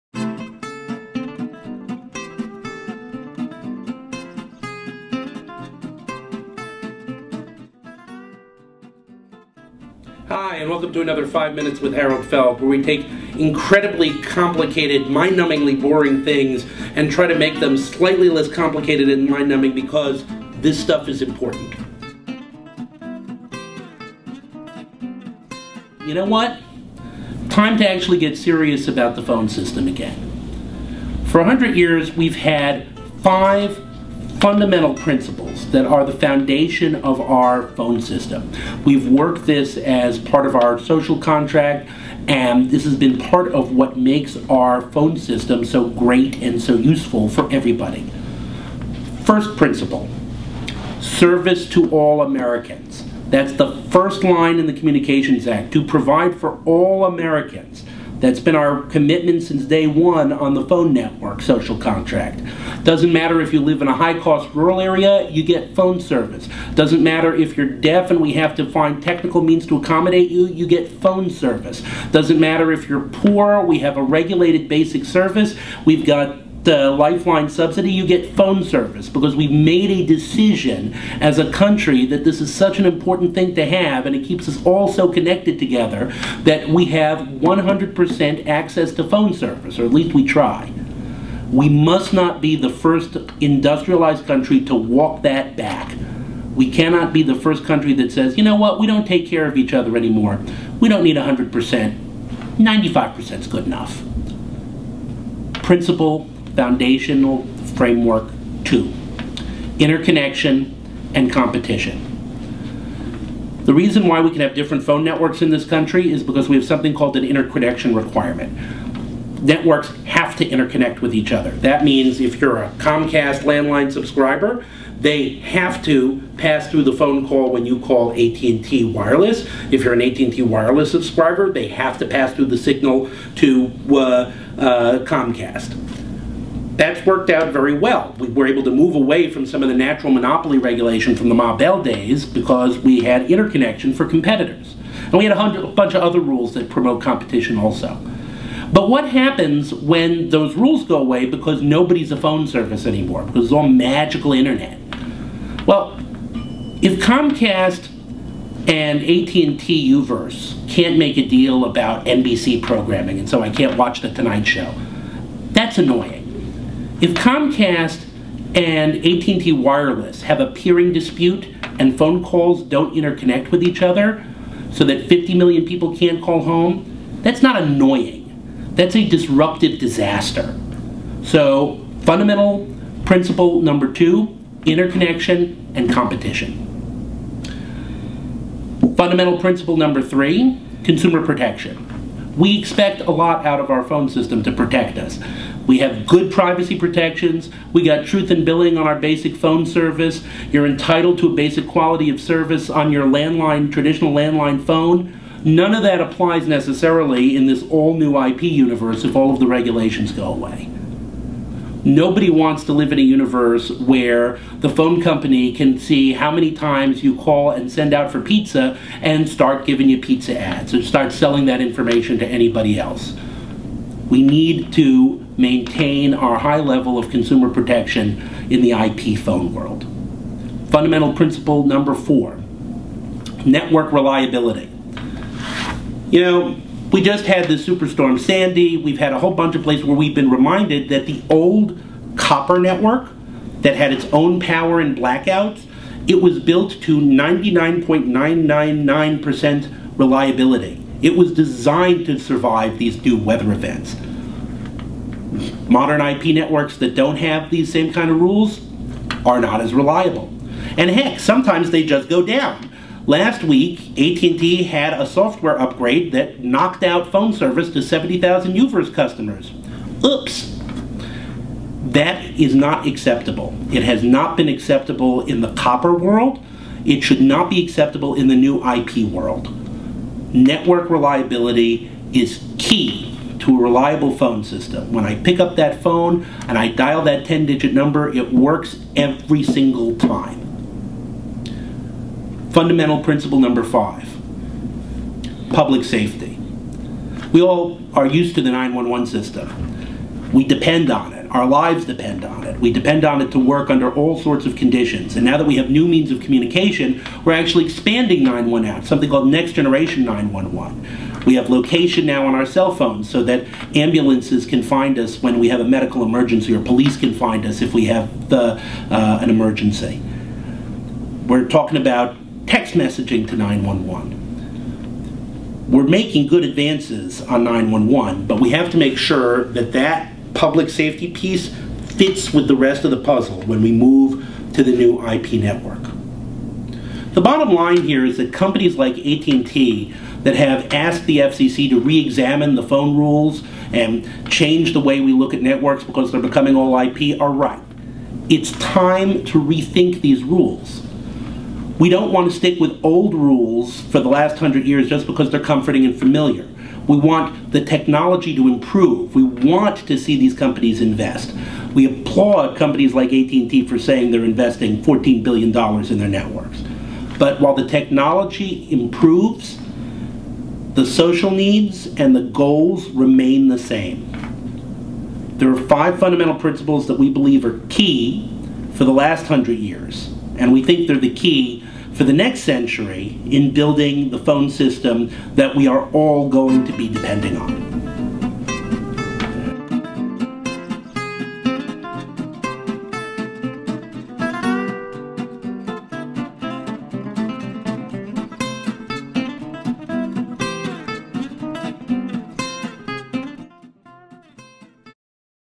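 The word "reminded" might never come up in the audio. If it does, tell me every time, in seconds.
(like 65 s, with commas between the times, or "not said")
240 s.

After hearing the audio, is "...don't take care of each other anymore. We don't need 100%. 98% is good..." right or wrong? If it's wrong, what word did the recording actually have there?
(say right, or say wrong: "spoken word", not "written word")
wrong: "95", not "98".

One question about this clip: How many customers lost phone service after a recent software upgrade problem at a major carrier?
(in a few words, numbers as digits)
70,000.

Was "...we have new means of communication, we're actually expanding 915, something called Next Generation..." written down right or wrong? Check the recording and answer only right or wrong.
wrong.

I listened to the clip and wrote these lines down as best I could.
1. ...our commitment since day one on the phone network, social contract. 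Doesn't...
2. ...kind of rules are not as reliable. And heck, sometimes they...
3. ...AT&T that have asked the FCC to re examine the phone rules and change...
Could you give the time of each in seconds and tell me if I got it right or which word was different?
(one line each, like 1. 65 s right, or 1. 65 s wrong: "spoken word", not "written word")
1. 58 s right
2. 257 s right
3. 338 s right.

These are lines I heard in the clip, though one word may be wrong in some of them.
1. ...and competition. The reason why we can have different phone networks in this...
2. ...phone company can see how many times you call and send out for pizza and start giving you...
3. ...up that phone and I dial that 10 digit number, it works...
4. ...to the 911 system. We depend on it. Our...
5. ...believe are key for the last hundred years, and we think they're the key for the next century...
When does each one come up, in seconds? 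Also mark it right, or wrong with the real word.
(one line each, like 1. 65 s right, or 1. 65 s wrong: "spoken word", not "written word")
1. 111 s right
2. 214 s right
3. 285 s right
4. 298 s right
5. 377 s right.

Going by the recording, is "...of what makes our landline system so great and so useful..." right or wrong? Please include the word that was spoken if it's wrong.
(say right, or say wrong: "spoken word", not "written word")
wrong: "phone", not "landline".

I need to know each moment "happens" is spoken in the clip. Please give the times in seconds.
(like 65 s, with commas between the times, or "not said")
149 s.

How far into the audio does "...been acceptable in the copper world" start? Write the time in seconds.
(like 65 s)
274 s.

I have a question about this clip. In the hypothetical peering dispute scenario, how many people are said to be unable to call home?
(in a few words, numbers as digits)
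50 million.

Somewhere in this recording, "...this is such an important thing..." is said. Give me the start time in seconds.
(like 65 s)
82 s.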